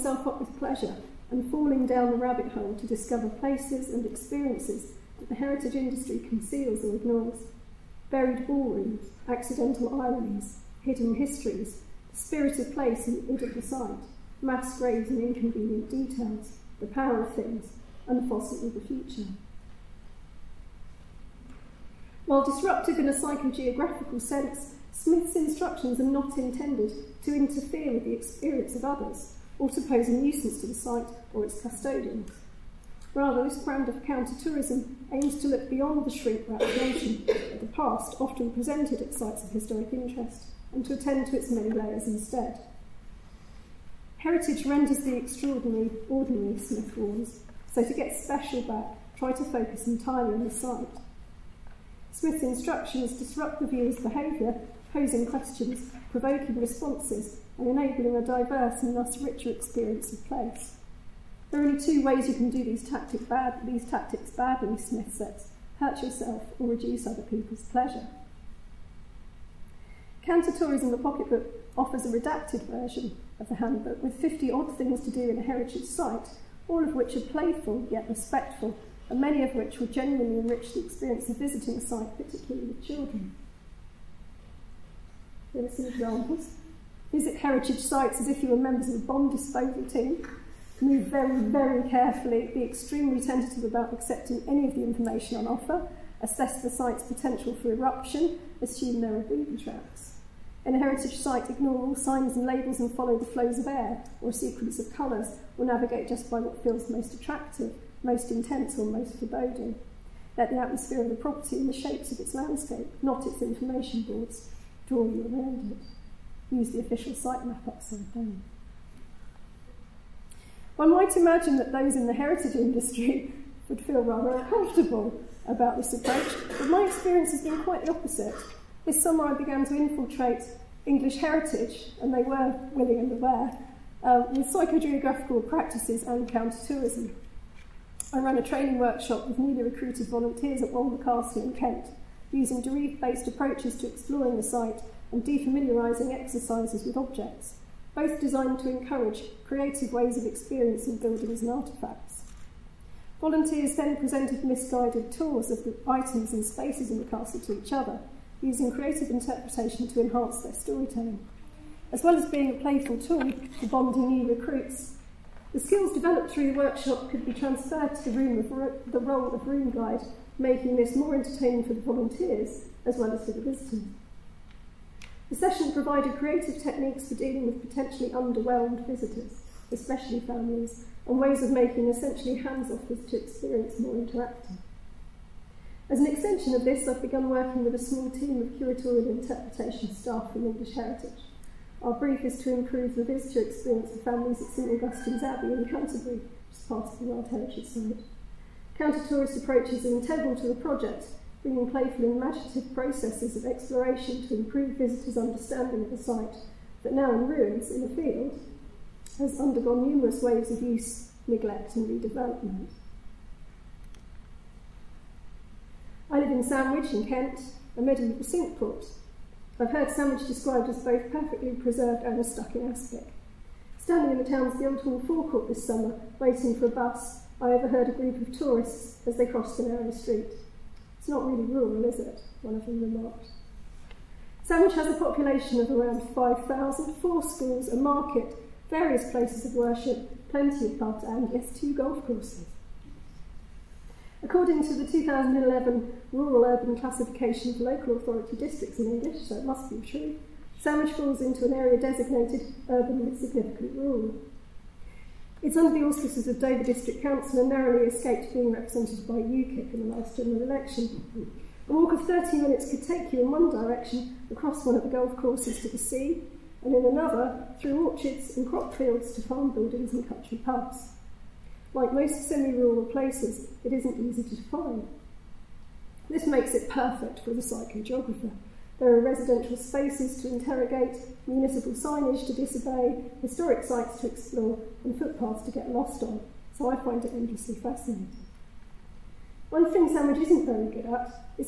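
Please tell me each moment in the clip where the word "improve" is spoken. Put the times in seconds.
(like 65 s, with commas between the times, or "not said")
192 s, 204 s.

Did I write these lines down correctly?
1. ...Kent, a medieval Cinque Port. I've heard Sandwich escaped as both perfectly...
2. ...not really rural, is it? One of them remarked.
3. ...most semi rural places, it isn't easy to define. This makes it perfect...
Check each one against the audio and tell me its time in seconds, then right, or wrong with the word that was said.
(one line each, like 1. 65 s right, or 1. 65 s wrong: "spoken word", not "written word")
1. 217 s wrong: "described", not "escaped"
2. 231 s right
3. 271 s right.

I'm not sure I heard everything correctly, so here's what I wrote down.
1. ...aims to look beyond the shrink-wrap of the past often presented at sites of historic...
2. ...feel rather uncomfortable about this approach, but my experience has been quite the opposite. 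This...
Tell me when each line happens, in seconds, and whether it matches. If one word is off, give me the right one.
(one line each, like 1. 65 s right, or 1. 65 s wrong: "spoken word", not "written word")
1. 35 s right
2. 123 s right.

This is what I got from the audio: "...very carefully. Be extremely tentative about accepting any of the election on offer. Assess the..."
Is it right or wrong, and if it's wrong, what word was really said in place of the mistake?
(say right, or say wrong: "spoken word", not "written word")
wrong: "information", not "election".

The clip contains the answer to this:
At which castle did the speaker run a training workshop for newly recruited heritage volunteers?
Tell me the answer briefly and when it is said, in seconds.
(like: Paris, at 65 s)
Walmer Castle, at 140 s.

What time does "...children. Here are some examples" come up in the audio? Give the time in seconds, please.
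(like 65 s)
82 s.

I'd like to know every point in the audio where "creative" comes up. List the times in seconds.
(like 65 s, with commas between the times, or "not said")
149 s, 158 s, 176 s.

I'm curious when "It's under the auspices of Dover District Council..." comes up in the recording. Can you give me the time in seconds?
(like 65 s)
255 s.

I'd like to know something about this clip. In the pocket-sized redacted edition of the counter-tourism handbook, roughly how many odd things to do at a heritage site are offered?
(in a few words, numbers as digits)
50.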